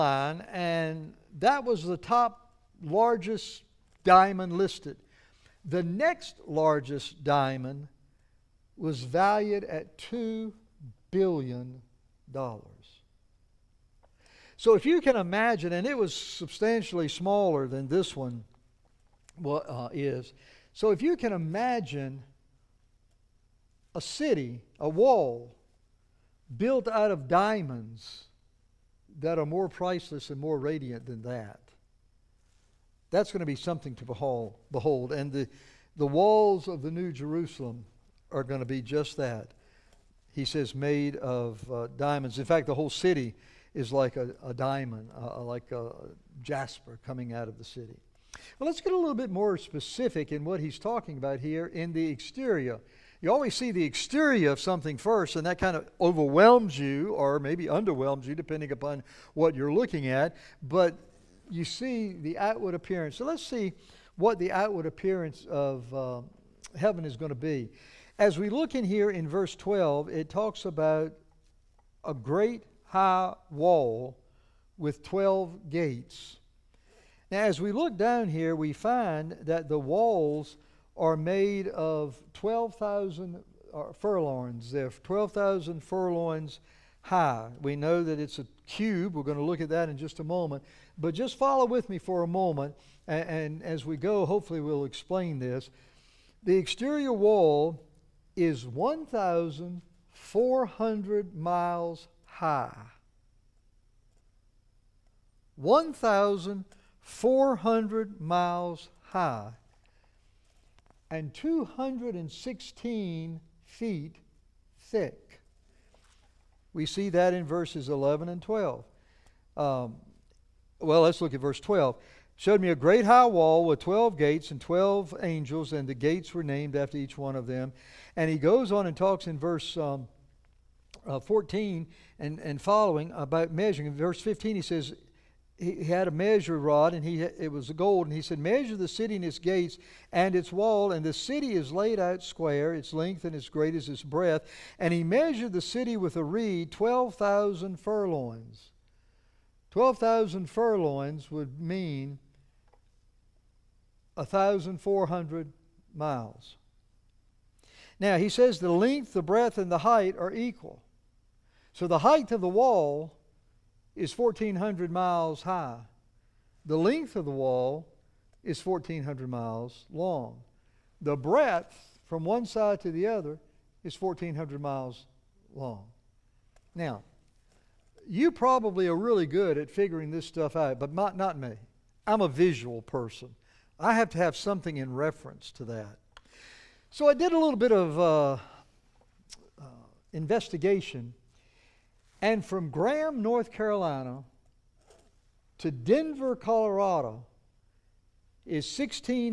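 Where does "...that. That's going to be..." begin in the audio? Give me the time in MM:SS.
00:31.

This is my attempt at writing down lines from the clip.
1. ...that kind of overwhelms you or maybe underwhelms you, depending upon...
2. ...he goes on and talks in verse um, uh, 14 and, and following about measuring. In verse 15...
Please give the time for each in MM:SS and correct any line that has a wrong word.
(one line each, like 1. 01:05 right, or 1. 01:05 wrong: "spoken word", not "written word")
1. 00:55 right
2. 02:08 right.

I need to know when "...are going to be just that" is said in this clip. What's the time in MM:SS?
00:38.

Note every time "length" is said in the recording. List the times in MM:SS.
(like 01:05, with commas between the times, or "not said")
02:22, 02:38, 02:46.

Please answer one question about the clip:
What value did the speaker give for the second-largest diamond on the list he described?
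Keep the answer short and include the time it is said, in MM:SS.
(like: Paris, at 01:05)
$2 billion, at 00:09.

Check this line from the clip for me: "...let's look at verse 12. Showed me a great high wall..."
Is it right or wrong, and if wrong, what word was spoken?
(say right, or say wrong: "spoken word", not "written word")
right.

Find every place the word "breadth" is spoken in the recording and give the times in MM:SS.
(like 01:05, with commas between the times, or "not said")
02:24, 02:39, 02:51.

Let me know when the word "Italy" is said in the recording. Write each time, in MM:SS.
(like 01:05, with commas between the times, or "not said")
not said.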